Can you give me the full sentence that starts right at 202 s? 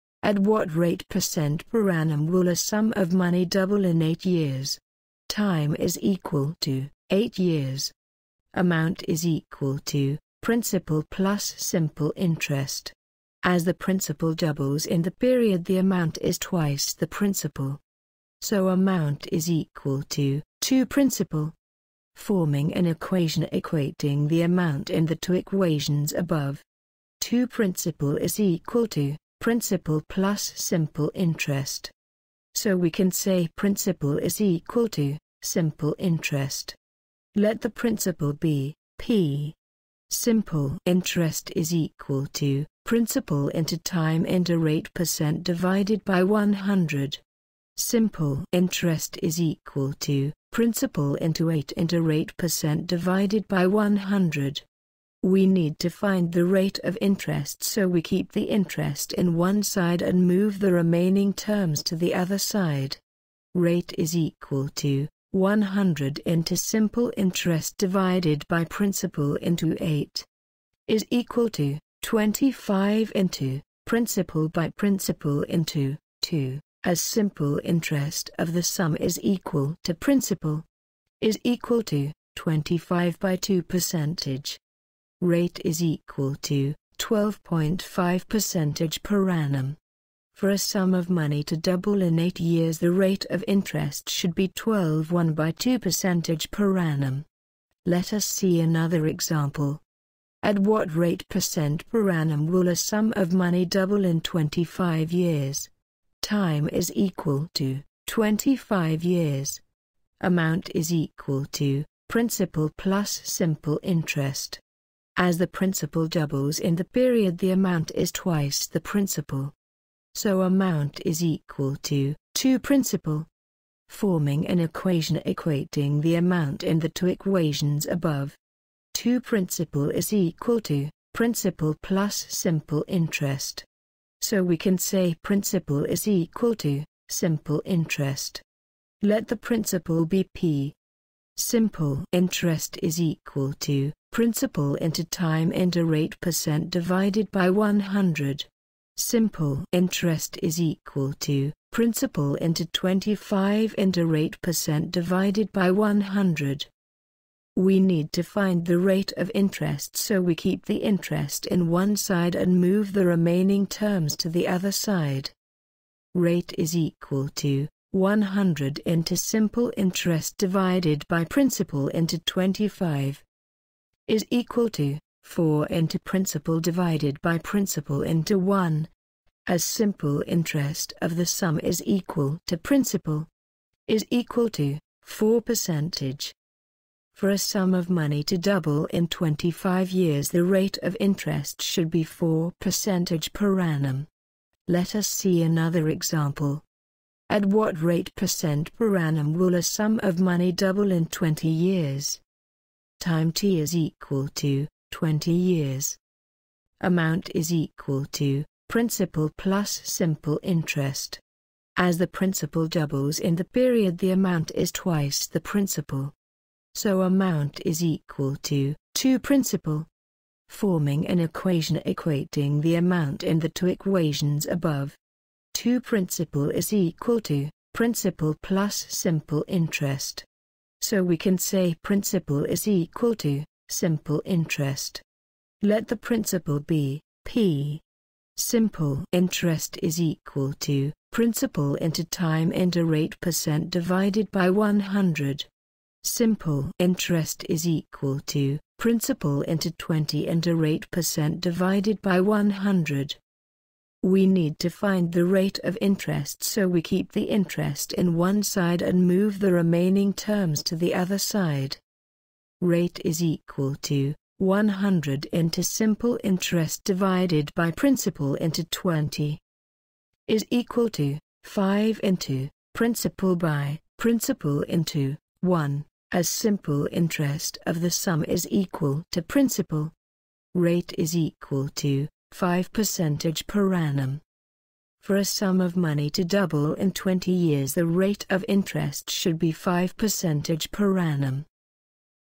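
Time t is equal to 20 years.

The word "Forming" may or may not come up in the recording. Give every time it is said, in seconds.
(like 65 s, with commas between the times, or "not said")
22 s, 123 s, 220 s.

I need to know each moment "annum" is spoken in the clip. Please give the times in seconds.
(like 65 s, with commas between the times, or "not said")
1 s, 89 s, 96 s, 102 s, 193 s, 198 s, 283 s, 290 s.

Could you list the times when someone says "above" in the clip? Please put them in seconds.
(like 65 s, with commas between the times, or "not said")
26 s, 127 s, 224 s.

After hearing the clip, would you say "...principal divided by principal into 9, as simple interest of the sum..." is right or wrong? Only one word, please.
wrong.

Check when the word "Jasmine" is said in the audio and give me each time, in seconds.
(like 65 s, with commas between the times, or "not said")
not said.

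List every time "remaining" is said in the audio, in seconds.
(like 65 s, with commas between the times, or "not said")
60 s, 163 s, 259 s.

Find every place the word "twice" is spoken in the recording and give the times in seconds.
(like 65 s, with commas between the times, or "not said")
16 s, 118 s, 214 s.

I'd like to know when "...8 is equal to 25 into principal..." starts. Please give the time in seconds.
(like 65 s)
69 s.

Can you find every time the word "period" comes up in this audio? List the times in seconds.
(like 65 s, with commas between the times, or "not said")
15 s, 116 s, 213 s.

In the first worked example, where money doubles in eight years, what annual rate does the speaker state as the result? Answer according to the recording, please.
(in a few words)
12.5%.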